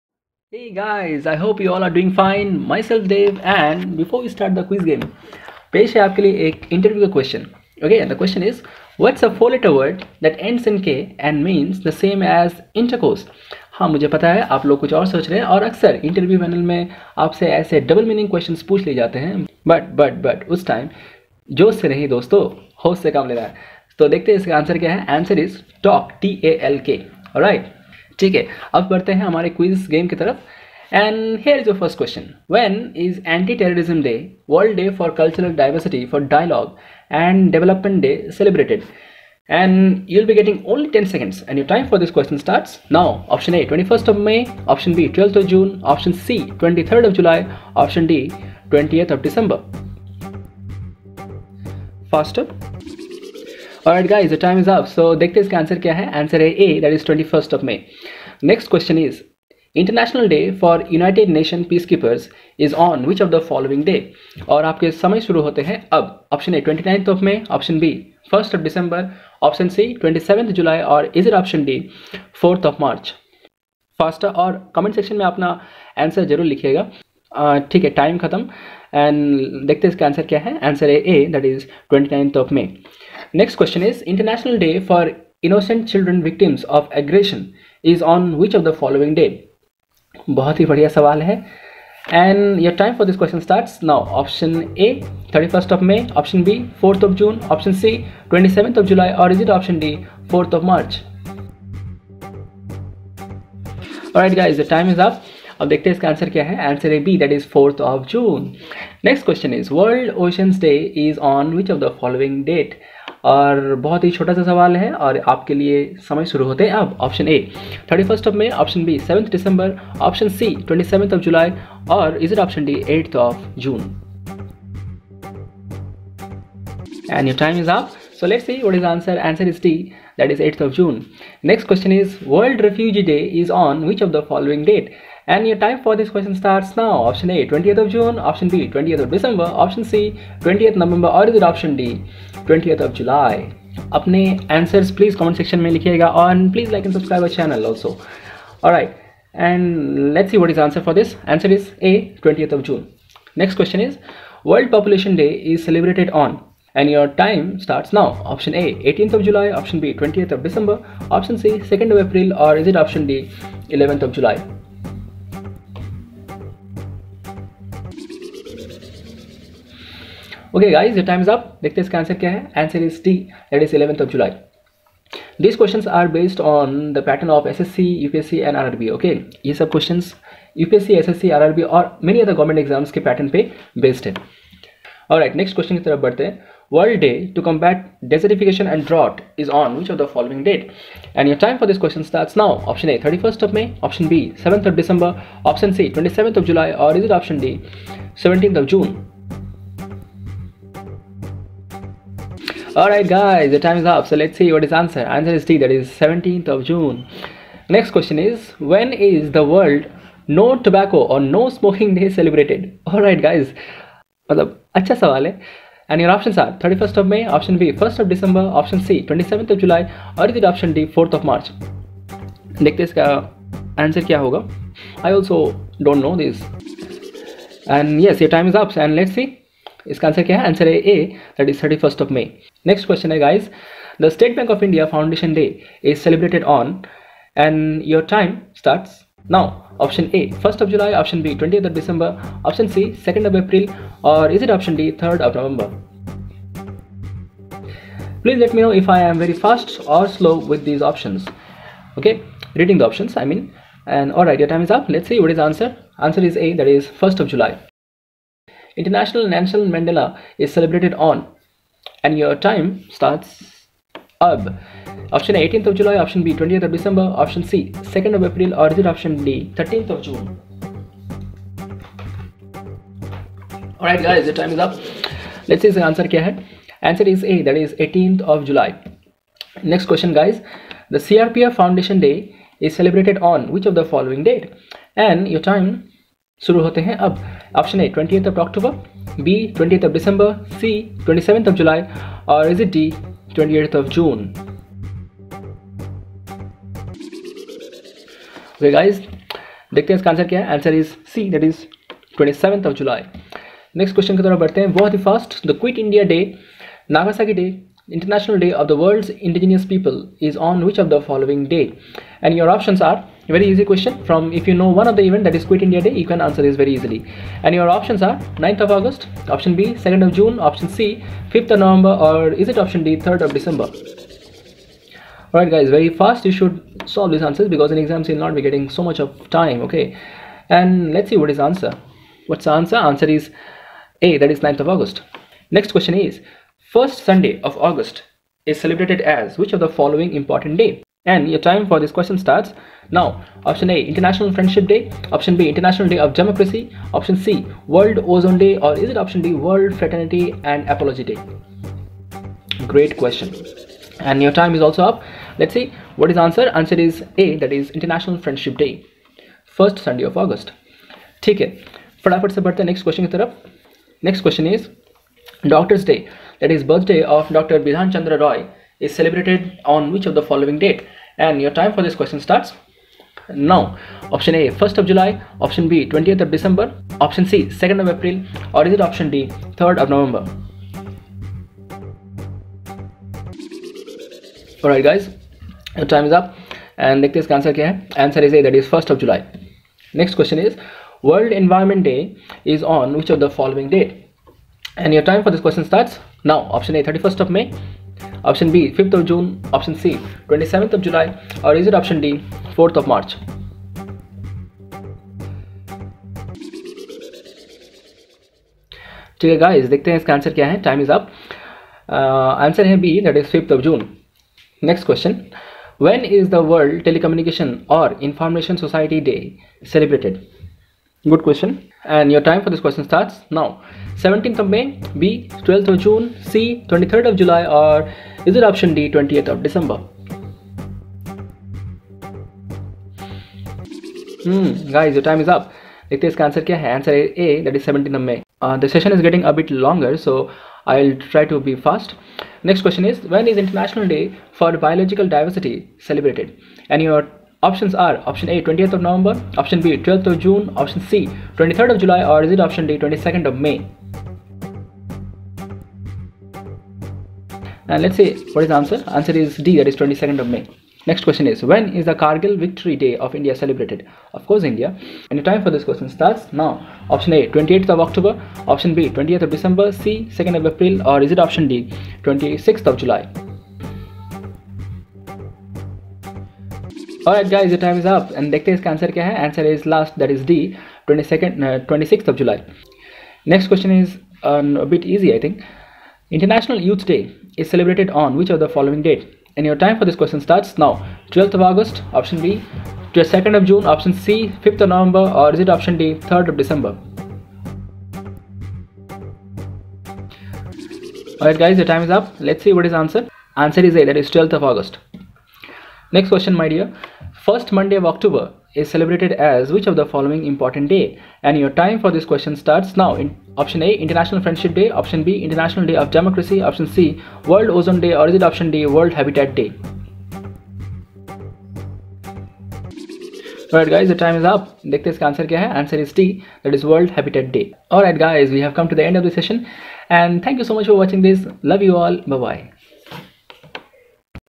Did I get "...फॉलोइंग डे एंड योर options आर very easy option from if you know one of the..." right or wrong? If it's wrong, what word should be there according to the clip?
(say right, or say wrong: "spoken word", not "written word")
wrong: "question", not "option".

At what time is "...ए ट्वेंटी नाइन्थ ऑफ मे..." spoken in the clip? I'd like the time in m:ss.
1:06.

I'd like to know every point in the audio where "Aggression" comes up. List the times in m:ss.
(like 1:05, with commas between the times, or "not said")
1:26.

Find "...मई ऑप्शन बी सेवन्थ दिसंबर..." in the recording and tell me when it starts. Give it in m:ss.
1:58.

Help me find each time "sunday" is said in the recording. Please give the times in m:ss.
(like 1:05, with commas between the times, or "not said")
5:37, 5:59.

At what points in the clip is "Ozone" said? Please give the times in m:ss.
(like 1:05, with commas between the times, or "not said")
5:48, 8:37.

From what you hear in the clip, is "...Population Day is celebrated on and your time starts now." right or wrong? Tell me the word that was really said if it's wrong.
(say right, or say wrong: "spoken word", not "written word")
right.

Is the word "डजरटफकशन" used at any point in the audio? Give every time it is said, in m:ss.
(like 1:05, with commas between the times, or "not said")
3:08.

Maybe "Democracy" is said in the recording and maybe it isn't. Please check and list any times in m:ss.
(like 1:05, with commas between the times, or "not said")
5:46, 8:35.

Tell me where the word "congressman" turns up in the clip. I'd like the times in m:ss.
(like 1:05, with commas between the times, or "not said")
not said.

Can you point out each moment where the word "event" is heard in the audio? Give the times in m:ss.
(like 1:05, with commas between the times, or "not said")
5:15.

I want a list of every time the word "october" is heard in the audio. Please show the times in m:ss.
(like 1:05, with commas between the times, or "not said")
7:47, 8:27.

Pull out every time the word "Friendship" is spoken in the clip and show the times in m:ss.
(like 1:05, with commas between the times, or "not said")
5:44, 5:58, 8:34.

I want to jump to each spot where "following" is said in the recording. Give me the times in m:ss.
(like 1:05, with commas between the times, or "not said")
1:28, 4:43, 5:39, 6:10, 6:33, 8:08, 8:29.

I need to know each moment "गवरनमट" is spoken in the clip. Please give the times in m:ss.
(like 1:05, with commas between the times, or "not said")
3:02.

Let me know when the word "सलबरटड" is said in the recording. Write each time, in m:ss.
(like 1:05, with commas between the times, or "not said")
0:38, 3:55, 6:59.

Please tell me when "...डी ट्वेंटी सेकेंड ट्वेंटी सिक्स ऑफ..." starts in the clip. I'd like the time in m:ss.
8:01.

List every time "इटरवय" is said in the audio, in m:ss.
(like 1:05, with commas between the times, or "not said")
0:06, 0:16.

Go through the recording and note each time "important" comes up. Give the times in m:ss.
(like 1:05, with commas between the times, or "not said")
5:40, 8:30.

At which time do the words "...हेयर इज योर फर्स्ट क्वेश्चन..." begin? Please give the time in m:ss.
0:31.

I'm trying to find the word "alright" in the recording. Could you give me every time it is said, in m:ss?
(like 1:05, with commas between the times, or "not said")
2:28, 3:22, 3:32, 4:14, 4:33, 7:57, 8:21, 8:43.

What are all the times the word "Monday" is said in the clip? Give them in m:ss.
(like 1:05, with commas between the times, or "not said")
8:27.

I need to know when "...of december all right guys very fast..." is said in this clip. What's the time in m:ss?
5:23.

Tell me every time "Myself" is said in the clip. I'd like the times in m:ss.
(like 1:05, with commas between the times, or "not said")
0:02.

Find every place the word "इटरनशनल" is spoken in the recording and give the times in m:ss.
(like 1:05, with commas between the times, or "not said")
0:59, 5:07.